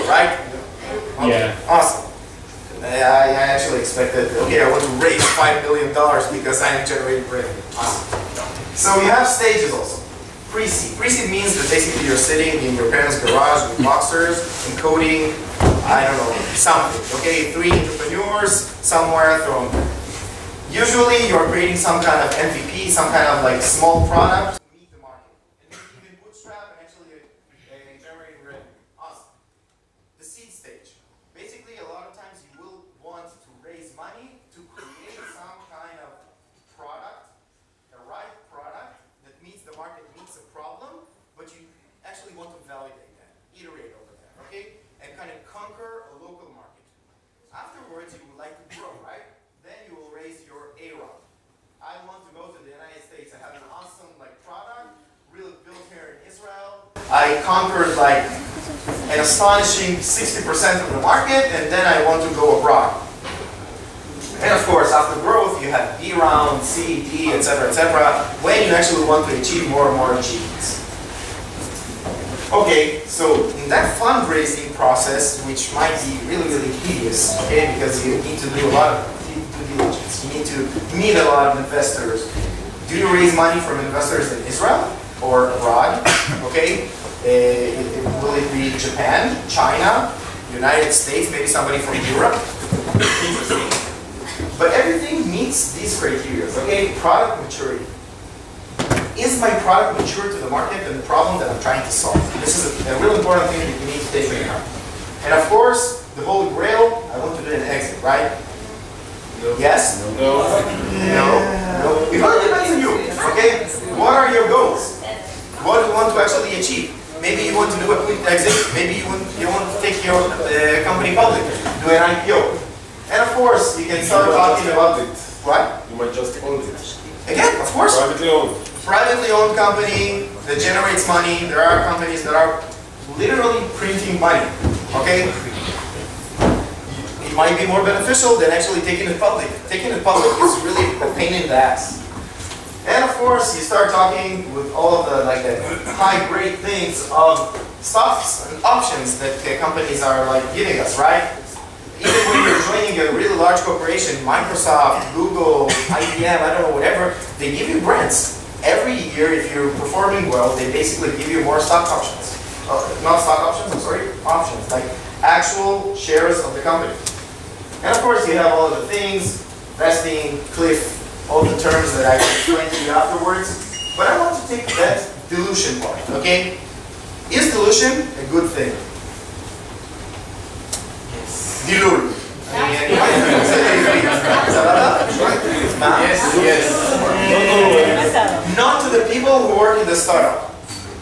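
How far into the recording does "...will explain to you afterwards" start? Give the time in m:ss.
2:52.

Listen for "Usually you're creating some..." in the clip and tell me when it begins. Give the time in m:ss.
0:20.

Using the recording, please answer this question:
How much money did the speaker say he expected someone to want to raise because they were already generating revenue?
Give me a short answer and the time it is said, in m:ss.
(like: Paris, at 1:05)
$5 million, at 0:05.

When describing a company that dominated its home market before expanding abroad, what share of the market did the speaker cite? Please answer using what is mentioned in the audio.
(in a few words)
60%.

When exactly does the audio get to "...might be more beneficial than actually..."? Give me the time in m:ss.
2:17.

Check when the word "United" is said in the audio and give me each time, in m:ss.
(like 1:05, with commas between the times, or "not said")
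0:52, 1:30.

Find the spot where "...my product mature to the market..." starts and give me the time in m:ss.
1:39.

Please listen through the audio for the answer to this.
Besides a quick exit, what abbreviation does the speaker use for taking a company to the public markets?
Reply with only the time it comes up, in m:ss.
2:02.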